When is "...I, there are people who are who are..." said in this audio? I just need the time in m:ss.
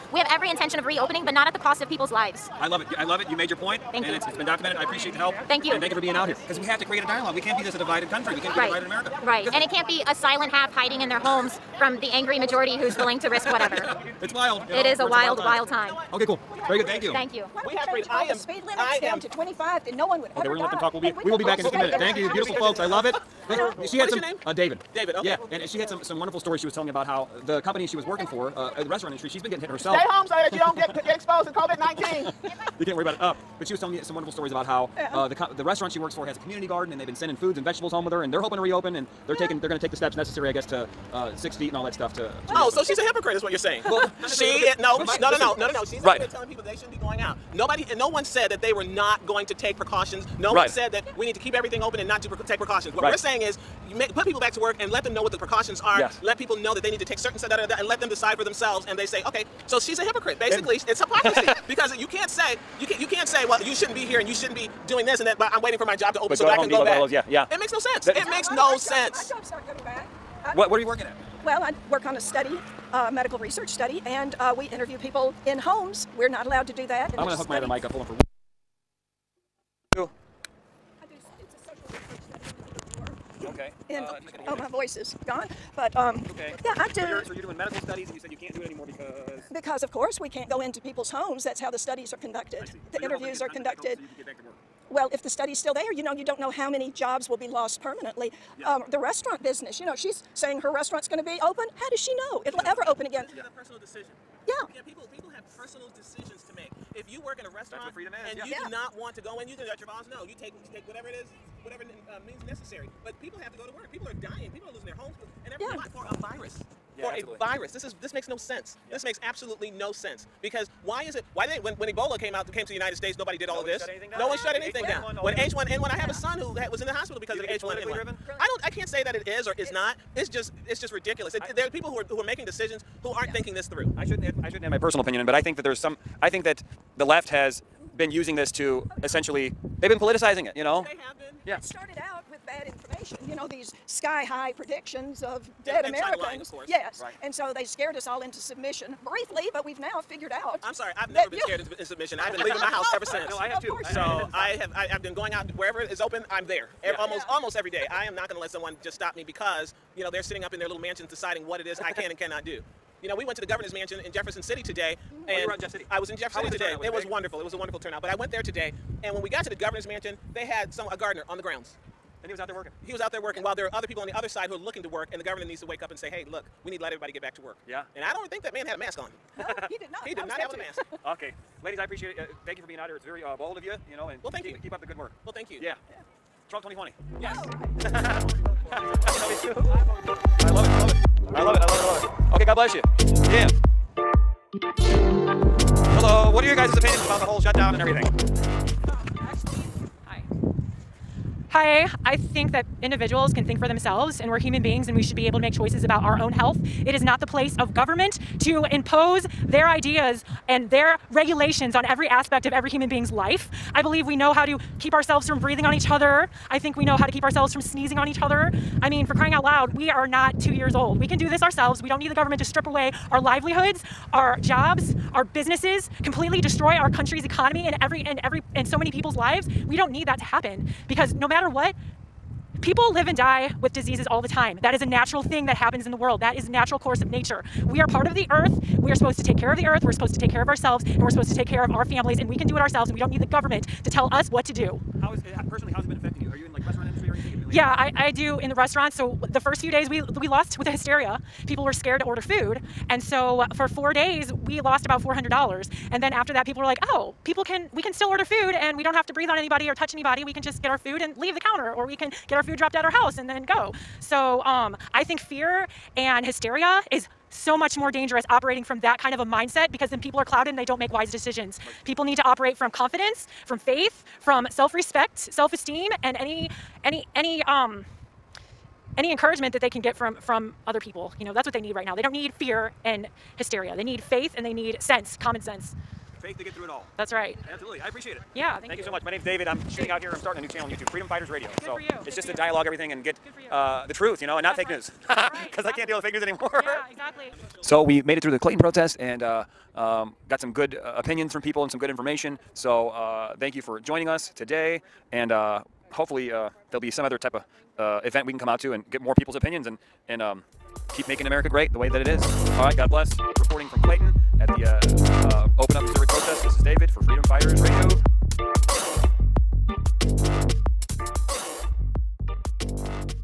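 2:11.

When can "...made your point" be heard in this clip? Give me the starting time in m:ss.
0:03.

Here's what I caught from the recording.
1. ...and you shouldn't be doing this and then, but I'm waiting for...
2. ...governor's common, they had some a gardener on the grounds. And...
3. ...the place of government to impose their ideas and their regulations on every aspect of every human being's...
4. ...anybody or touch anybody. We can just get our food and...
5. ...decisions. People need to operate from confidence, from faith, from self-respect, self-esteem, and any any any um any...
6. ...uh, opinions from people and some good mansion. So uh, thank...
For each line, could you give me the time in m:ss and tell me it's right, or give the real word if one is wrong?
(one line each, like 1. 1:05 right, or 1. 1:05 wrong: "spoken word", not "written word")
1. 1:04 right
2. 2:49 wrong: "mansion", not "common"
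3. 3:27 right
4. 4:19 right
5. 4:31 right
6. 5:00 wrong: "information", not "mansion".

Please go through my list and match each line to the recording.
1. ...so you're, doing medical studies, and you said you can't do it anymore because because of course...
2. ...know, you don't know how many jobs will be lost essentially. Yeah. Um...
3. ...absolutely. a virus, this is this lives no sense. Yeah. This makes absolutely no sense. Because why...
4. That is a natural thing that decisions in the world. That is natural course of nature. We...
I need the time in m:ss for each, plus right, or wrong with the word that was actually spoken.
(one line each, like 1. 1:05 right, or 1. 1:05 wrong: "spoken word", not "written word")
1. 1:27 right
2. 1:36 wrong: "permanently", not "essentially"
3. 1:57 wrong: "makes", not "lives"
4. 3:54 wrong: "happens", not "decisions".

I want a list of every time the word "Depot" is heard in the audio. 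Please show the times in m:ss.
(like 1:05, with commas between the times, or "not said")
1:06.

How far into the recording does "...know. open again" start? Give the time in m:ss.
1:42.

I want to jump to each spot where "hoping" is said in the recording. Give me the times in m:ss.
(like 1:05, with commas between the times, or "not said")
0:38.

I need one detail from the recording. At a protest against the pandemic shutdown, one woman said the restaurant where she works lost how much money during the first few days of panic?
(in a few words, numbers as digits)
$400.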